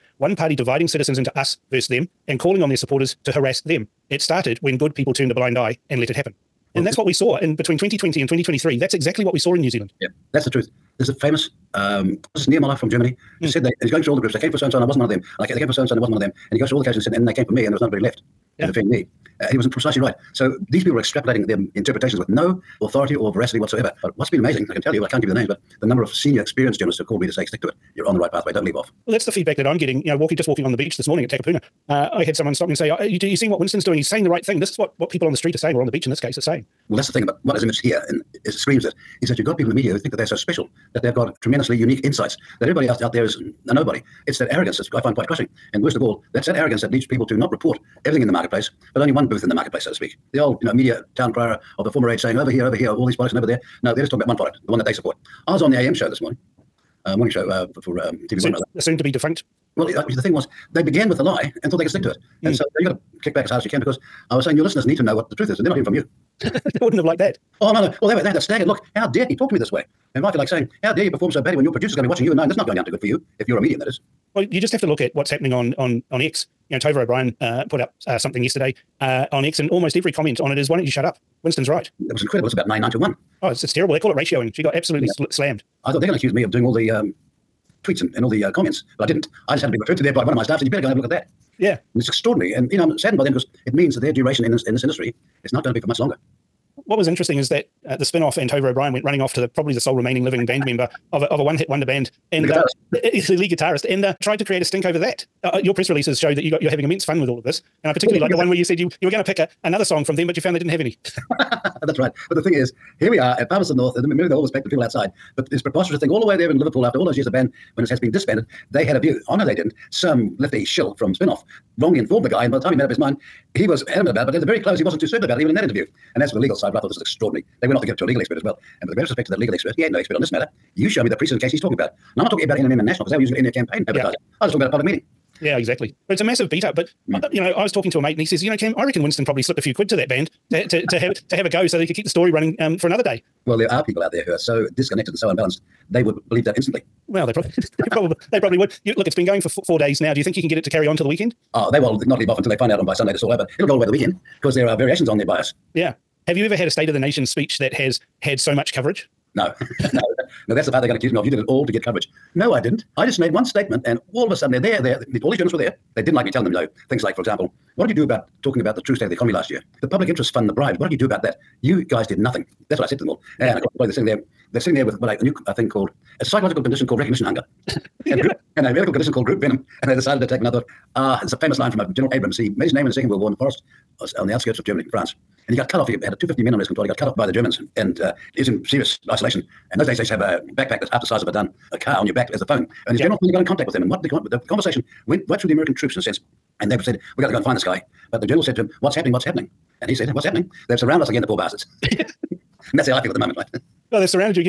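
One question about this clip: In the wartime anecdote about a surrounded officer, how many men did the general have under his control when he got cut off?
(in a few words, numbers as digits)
250.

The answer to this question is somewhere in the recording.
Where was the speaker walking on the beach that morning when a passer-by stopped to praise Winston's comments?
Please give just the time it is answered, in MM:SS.
00:31.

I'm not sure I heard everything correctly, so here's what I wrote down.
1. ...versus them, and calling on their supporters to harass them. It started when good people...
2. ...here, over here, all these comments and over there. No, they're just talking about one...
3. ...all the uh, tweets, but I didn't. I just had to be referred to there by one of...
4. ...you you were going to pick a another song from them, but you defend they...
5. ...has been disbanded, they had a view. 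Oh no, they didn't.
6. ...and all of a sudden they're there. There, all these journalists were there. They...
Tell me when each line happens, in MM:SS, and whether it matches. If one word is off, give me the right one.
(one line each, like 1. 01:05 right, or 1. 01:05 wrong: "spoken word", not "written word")
1. 00:01 right
2. 00:52 wrong: "products", not "comments"
3. 01:28 wrong: "comments", not "tweets"
4. 01:48 wrong: "found", not "defend"
5. 01:57 right
6. 02:43 right.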